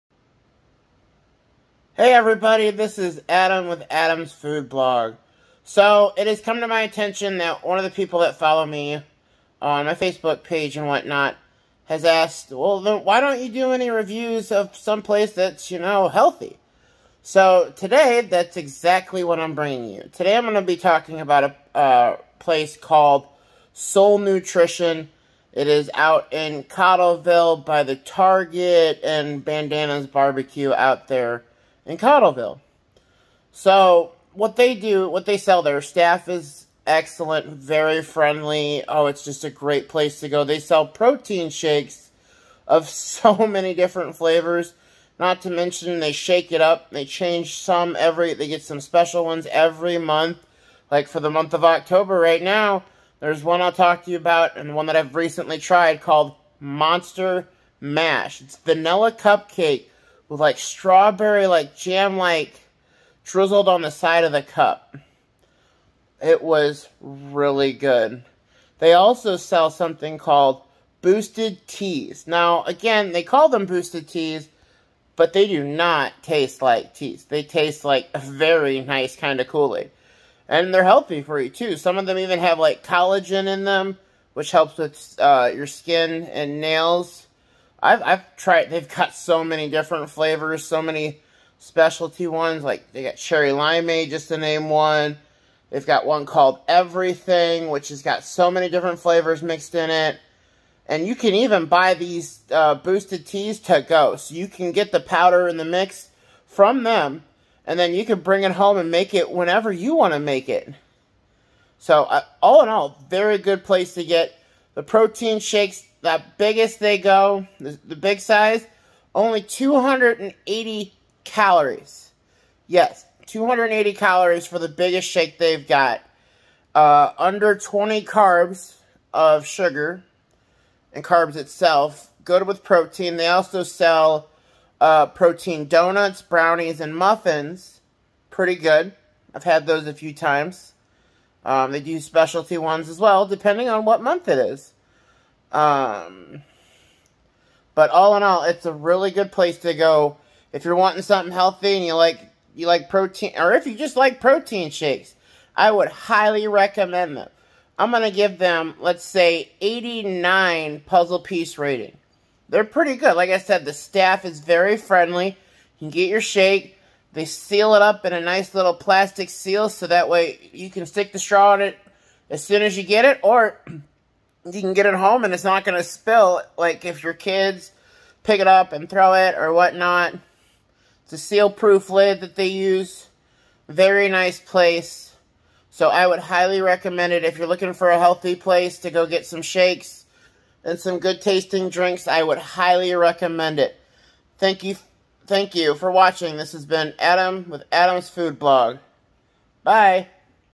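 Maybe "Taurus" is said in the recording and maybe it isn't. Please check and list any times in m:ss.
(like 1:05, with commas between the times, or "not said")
not said.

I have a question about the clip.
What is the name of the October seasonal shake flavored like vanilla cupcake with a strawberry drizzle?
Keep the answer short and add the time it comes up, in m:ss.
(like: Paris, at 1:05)
Monster Mash, at 0:56.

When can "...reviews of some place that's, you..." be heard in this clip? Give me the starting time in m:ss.
0:13.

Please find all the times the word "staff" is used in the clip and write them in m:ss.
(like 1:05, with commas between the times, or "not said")
0:35, 2:43.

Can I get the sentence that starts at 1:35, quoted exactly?
They've got one called Everything, which has got so many different flavors mixed in it.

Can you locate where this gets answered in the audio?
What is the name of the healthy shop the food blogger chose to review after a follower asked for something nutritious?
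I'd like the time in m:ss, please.
0:23.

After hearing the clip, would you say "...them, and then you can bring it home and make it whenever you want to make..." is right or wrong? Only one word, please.
right.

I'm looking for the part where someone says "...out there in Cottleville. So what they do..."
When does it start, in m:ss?
0:30.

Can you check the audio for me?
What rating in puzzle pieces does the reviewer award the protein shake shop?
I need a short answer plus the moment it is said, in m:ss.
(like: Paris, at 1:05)
89, at 2:39.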